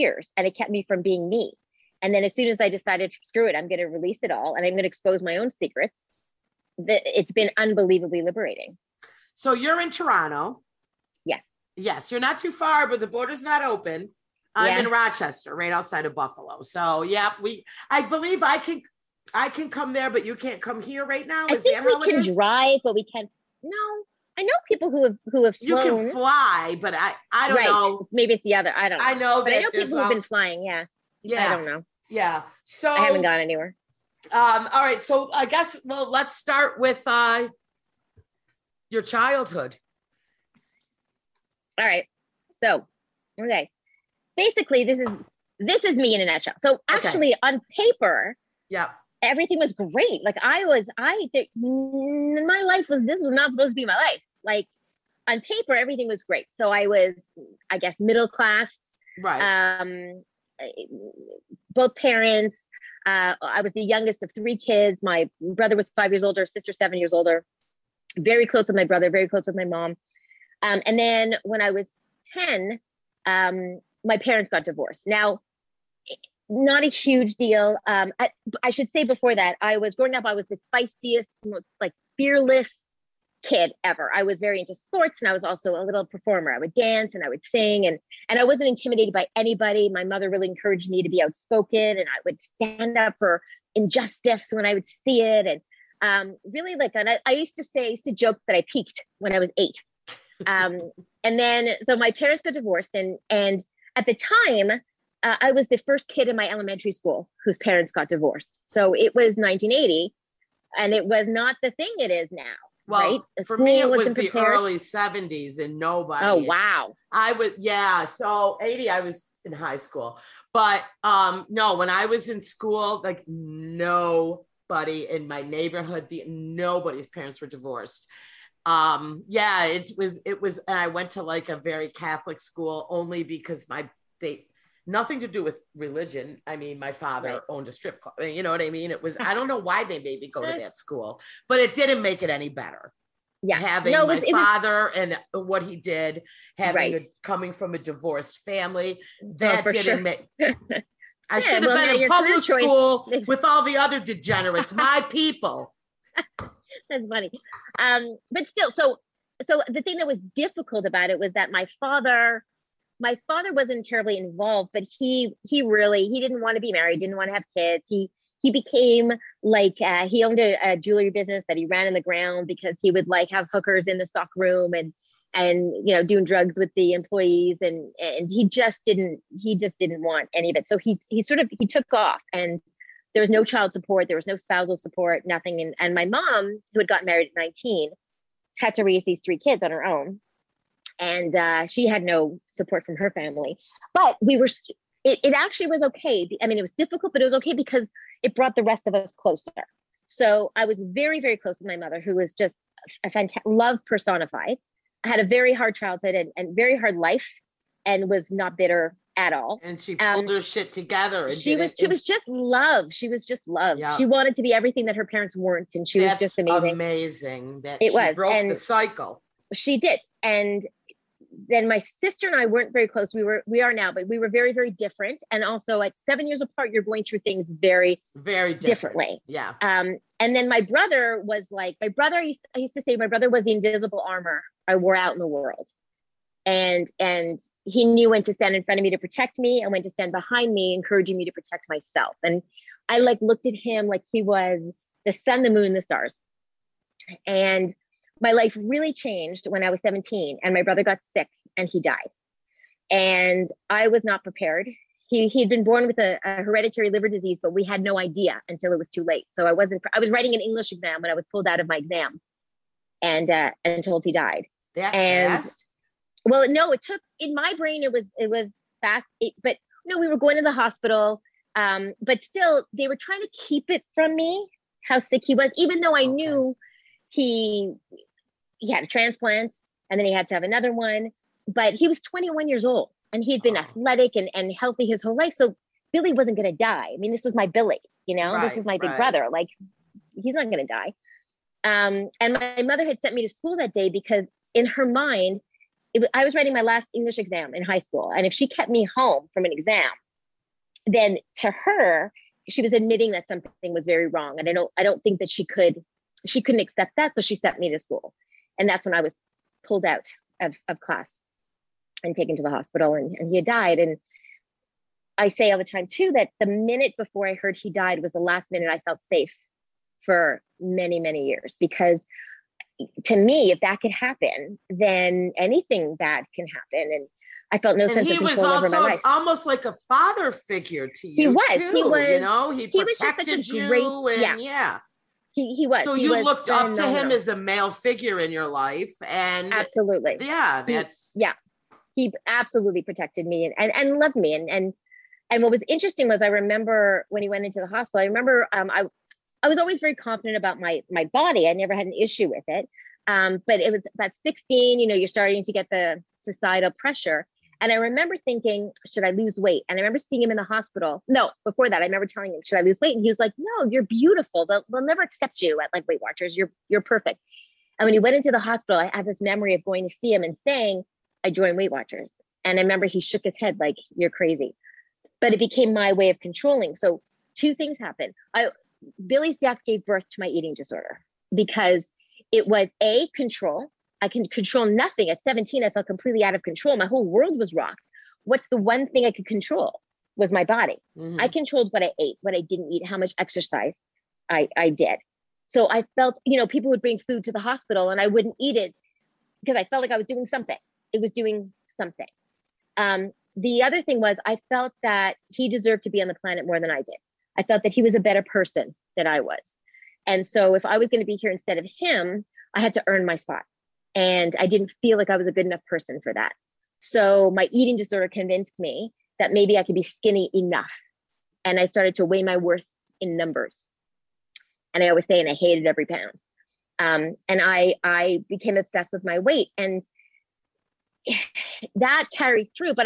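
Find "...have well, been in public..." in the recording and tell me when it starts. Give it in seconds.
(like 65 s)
151 s.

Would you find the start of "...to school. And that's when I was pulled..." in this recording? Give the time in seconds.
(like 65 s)
307 s.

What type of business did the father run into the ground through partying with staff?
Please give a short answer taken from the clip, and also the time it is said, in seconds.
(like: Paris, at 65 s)
Jewelry business, at 170 s.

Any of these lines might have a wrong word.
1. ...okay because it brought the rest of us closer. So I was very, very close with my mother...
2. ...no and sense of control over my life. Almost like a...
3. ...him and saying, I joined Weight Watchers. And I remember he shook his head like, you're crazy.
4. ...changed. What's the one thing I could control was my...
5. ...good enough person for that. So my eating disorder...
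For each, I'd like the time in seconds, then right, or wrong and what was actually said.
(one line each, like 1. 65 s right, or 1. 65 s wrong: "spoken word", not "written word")
1. 197 s right
2. 327 s right
3. 370 s right
4. 387 s wrong: "rocked", not "changed"
5. 415 s right.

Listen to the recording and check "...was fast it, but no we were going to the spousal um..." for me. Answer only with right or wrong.
wrong.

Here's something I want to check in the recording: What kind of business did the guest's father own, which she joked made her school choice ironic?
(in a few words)
A strip club.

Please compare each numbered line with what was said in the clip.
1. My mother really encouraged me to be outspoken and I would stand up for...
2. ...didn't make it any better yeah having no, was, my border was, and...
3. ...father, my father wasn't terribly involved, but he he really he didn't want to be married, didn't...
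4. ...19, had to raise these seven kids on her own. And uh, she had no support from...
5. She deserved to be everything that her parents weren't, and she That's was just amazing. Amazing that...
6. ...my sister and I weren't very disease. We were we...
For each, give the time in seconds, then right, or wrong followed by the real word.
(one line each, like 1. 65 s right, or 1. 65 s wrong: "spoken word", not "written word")
1. 89 s right
2. 141 s wrong: "father", not "border"
3. 161 s right
4. 187 s wrong: "three", not "seven"
5. 213 s wrong: "wanted", not "deserved"
6. 221 s wrong: "close", not "disease".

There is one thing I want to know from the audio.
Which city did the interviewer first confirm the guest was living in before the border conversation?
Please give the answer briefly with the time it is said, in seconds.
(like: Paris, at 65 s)
Toronto, at 9 s.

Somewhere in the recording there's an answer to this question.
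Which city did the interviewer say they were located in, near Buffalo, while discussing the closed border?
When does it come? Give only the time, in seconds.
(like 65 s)
14 s.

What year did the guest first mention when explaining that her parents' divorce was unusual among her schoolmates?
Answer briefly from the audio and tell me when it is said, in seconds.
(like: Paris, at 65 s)
1980, at 109 s.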